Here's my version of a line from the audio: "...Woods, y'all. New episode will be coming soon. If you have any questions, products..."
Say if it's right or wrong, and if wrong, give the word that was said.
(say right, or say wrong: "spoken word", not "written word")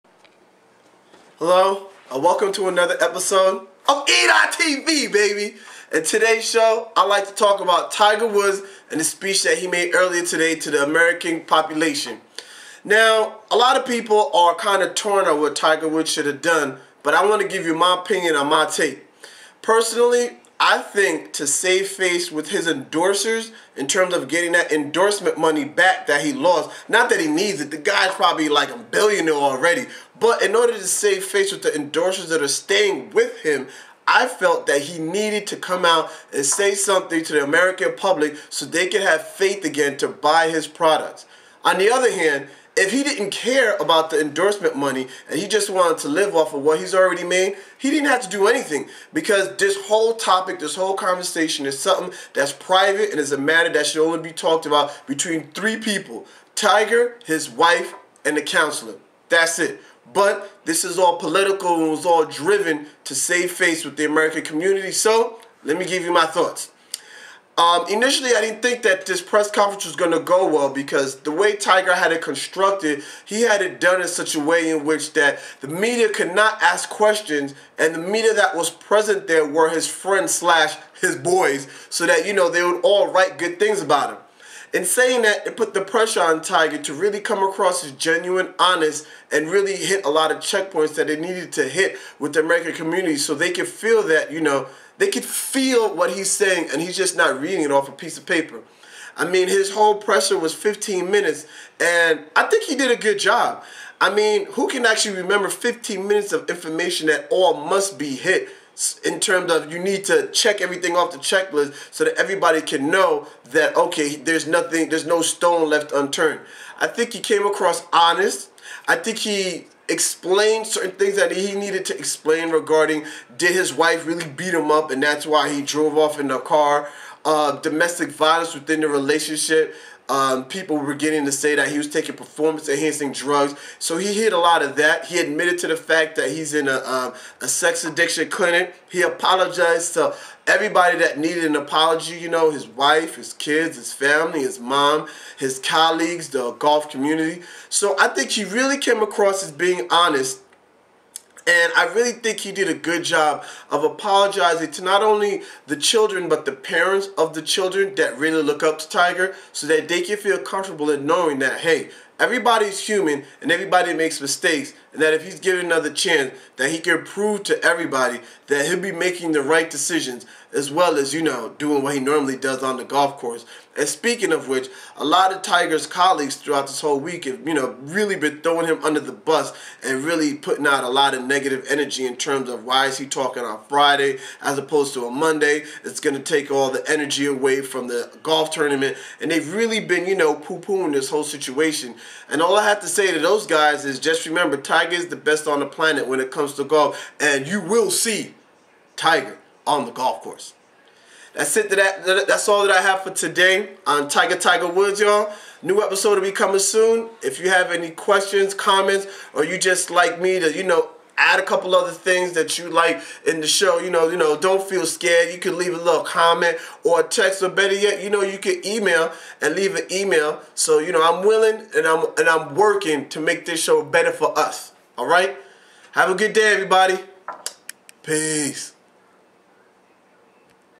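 wrong: "comments", not "products".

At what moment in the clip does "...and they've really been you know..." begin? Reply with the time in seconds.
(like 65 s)
189 s.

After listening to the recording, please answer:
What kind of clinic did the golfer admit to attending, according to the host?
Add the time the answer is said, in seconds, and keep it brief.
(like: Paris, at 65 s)
sex addiction clinic, at 137 s.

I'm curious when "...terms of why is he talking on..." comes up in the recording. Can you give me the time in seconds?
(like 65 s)
182 s.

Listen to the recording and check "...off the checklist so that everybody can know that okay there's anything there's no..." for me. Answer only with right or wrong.
wrong.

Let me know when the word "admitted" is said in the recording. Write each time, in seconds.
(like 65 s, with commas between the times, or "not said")
135 s.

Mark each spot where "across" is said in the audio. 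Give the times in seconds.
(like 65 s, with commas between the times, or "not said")
87 s, 117 s, 149 s.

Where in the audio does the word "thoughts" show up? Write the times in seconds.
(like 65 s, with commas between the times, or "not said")
66 s.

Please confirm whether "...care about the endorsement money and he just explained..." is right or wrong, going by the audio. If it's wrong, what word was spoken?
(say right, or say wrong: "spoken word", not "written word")
wrong: "wanted", not "explained".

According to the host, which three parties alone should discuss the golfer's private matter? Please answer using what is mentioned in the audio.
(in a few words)
Tiger, his wife, and the counselor.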